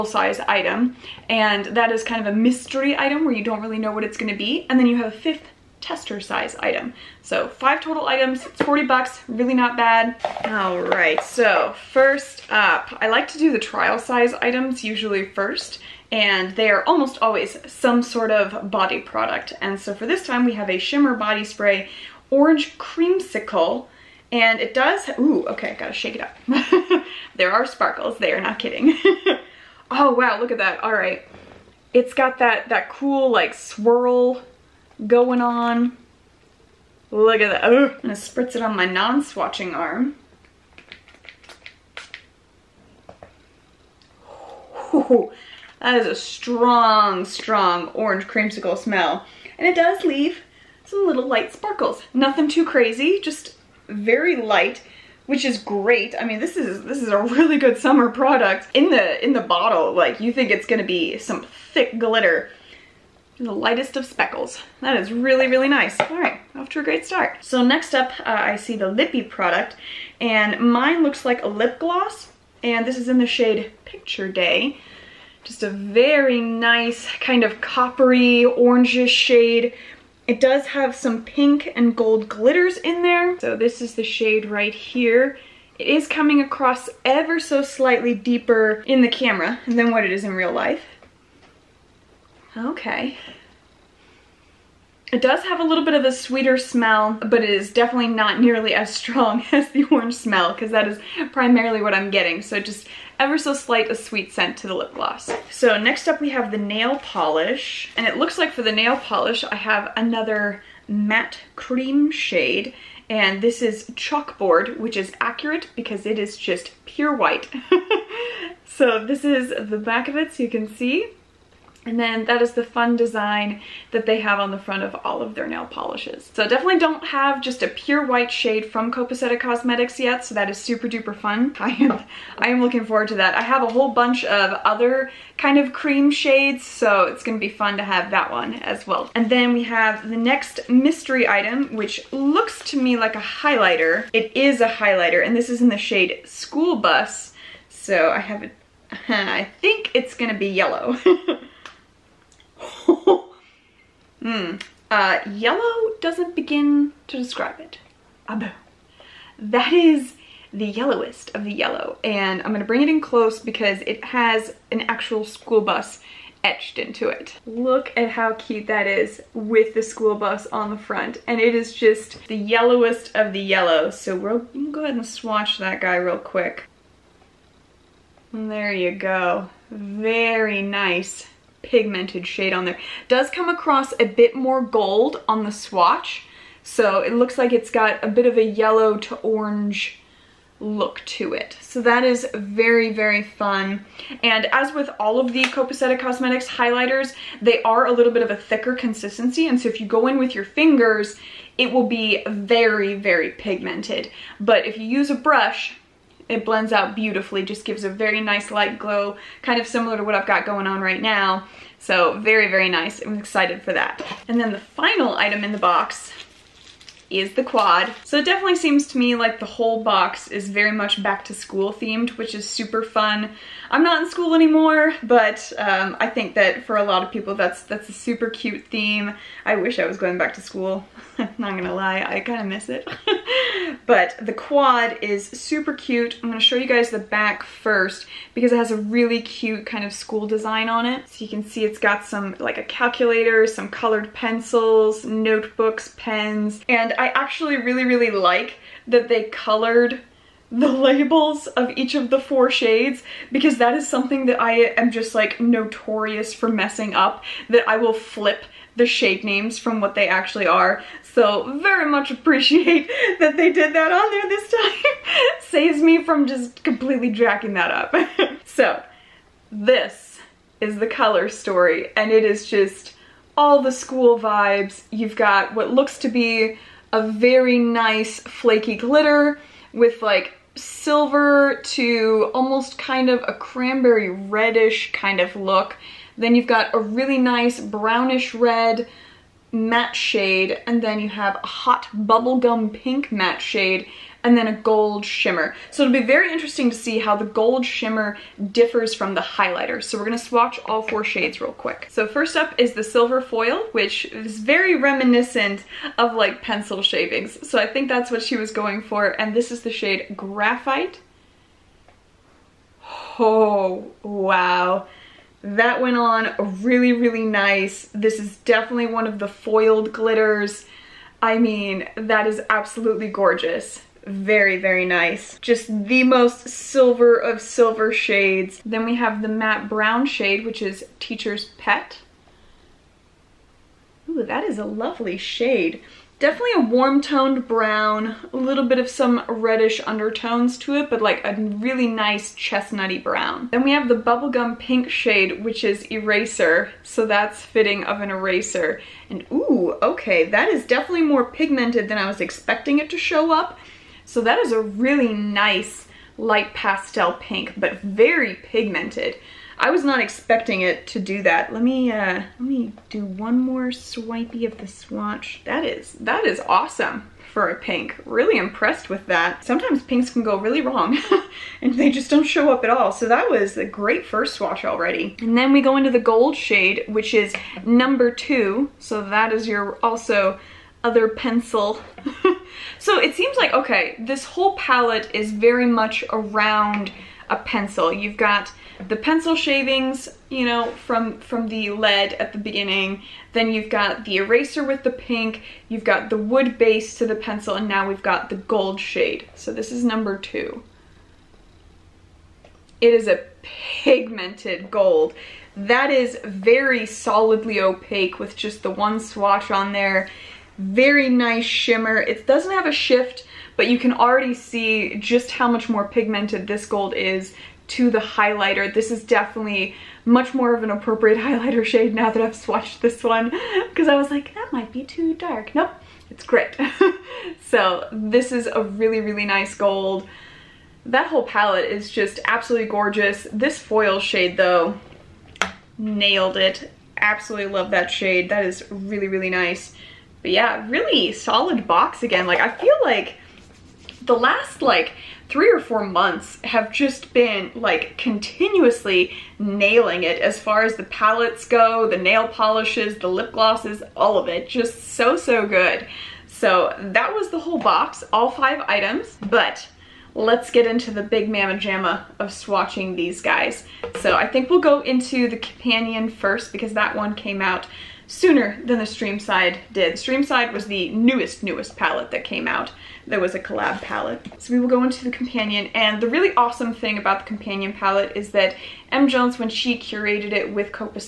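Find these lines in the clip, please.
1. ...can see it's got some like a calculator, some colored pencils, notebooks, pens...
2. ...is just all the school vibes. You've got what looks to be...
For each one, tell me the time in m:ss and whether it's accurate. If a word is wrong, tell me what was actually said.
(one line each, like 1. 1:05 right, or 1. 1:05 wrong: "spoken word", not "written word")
1. 4:01 right
2. 4:32 right.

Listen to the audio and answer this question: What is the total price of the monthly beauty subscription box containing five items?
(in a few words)
$40.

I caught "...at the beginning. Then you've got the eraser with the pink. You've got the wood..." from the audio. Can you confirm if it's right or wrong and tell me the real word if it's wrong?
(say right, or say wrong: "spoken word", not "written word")
right.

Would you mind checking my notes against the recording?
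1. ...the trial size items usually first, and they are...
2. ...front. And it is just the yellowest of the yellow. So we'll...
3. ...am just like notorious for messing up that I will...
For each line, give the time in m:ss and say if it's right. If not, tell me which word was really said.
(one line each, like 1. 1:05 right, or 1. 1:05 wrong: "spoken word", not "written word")
1. 0:13 right
2. 2:50 right
3. 4:14 right.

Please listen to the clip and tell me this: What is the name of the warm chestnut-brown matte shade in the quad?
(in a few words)
Teacher's Pet.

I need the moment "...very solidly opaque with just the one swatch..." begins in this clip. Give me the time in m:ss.
6:46.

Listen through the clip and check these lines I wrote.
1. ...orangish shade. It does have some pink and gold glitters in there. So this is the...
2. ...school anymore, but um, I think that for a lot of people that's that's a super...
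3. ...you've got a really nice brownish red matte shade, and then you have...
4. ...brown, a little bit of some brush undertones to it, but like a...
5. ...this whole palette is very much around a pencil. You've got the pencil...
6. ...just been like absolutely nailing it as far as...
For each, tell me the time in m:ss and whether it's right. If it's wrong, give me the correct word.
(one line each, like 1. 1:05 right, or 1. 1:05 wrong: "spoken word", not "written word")
1. 1:18 right
2. 3:44 right
3. 4:46 right
4. 5:37 wrong: "reddish", not "brush"
5. 6:23 right
6. 7:26 wrong: "continuously", not "absolutely".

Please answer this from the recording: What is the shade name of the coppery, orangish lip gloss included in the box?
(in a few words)
Picture Day.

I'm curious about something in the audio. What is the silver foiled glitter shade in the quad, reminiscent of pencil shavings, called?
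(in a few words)
Graphite.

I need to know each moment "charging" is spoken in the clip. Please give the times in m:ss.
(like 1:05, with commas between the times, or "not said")
not said.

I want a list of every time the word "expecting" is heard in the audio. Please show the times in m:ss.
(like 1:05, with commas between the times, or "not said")
5:52, 6:00.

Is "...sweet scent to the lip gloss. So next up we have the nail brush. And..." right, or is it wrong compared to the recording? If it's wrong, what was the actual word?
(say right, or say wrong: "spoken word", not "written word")
wrong: "polish", not "brush".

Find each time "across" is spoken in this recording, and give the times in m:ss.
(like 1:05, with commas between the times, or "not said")
1:26, 3:03.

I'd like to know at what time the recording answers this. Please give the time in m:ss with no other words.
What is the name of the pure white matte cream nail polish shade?
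1:53.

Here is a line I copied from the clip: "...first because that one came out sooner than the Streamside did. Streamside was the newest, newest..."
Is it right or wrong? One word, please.
right.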